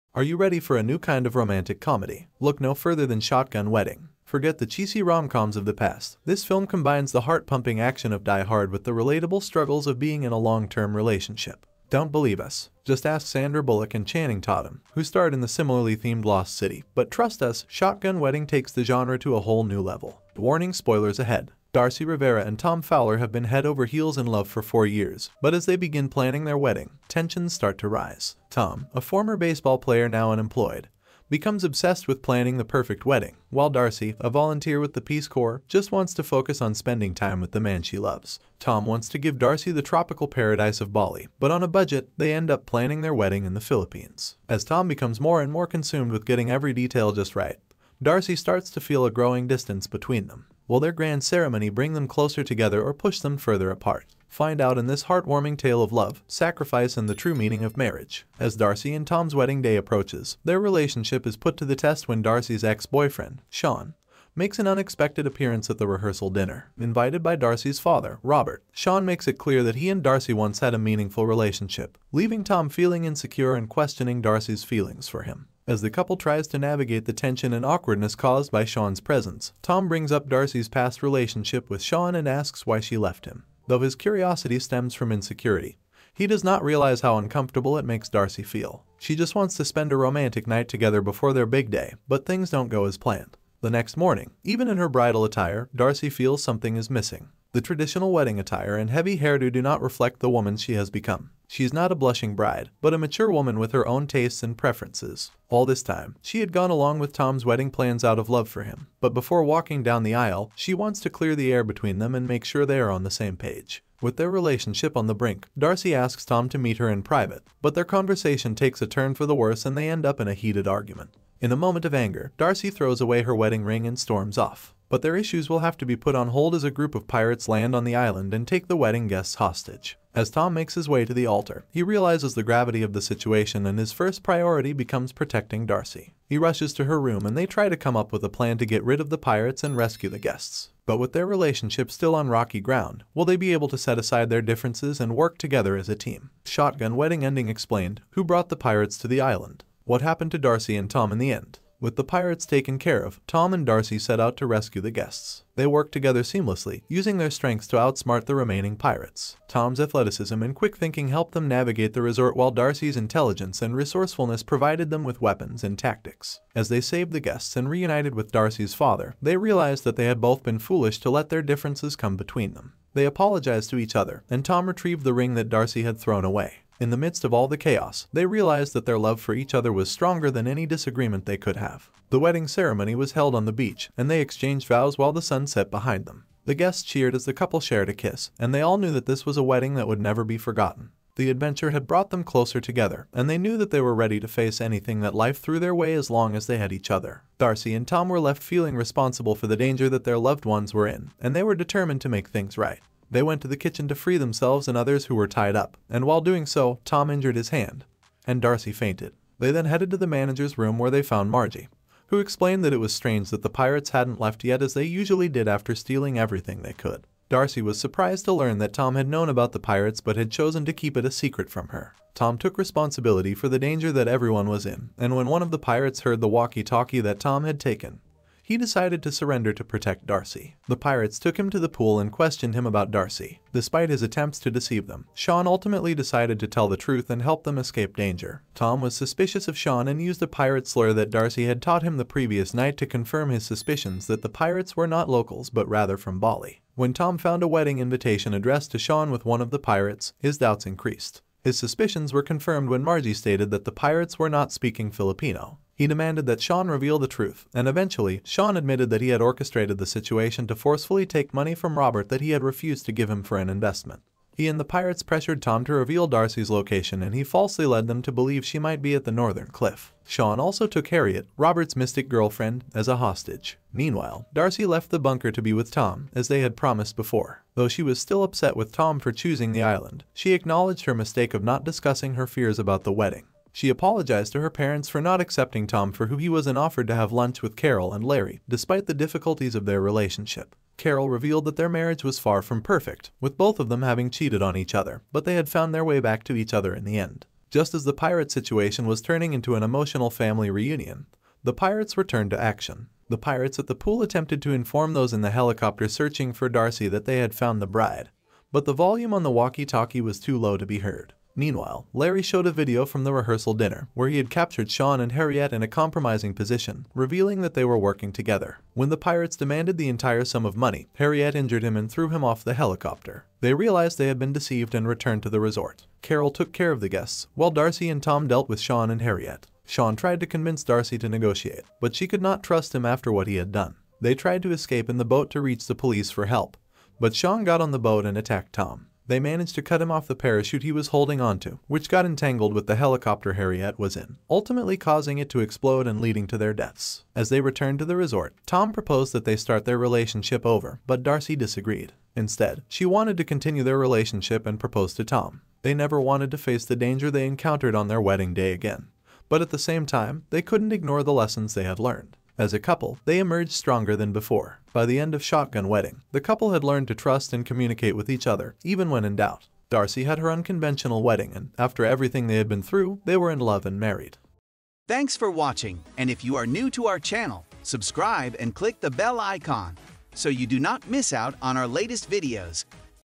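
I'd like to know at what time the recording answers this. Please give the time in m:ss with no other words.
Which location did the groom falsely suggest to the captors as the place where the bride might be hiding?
4:29.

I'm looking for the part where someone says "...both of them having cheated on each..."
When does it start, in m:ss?
4:53.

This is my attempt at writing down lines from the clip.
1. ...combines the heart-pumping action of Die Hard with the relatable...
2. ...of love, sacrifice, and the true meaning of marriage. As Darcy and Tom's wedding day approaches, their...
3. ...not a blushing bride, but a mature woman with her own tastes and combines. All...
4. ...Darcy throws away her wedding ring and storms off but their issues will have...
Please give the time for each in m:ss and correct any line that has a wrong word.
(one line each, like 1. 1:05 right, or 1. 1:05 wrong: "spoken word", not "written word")
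1. 0:06 right
2. 0:55 right
3. 1:41 wrong: "preferences", not "combines"
4. 2:02 right.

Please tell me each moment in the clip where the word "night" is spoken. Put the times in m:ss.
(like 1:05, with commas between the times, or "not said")
1:30, 4:02.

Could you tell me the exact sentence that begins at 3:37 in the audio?
Darcy was surprised to learn that Tom had known about the pirates but had chosen to keep it a secret from her.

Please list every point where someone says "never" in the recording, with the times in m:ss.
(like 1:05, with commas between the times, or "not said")
3:10, 5:55.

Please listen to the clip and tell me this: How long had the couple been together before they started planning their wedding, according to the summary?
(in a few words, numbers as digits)
4 years.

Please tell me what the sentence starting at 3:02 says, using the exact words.
The wedding ceremony was held on the beach, and they exchanged vows while the sun set behind them.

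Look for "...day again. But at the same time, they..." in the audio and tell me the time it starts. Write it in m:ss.
5:58.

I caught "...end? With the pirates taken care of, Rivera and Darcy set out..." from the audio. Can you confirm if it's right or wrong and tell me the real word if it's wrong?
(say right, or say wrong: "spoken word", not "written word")
wrong: "Tom", not "Rivera".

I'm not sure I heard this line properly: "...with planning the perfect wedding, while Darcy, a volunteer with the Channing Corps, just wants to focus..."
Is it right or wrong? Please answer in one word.
wrong.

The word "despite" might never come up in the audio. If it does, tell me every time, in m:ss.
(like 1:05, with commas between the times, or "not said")
3:53, 4:48.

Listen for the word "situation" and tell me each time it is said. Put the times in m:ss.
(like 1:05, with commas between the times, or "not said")
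2:13, 4:19, 4:58.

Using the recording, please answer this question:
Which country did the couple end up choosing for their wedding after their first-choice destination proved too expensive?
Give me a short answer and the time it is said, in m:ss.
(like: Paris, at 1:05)
Philippines, at 0:43.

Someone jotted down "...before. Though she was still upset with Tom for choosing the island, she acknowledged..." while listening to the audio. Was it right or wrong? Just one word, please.
right.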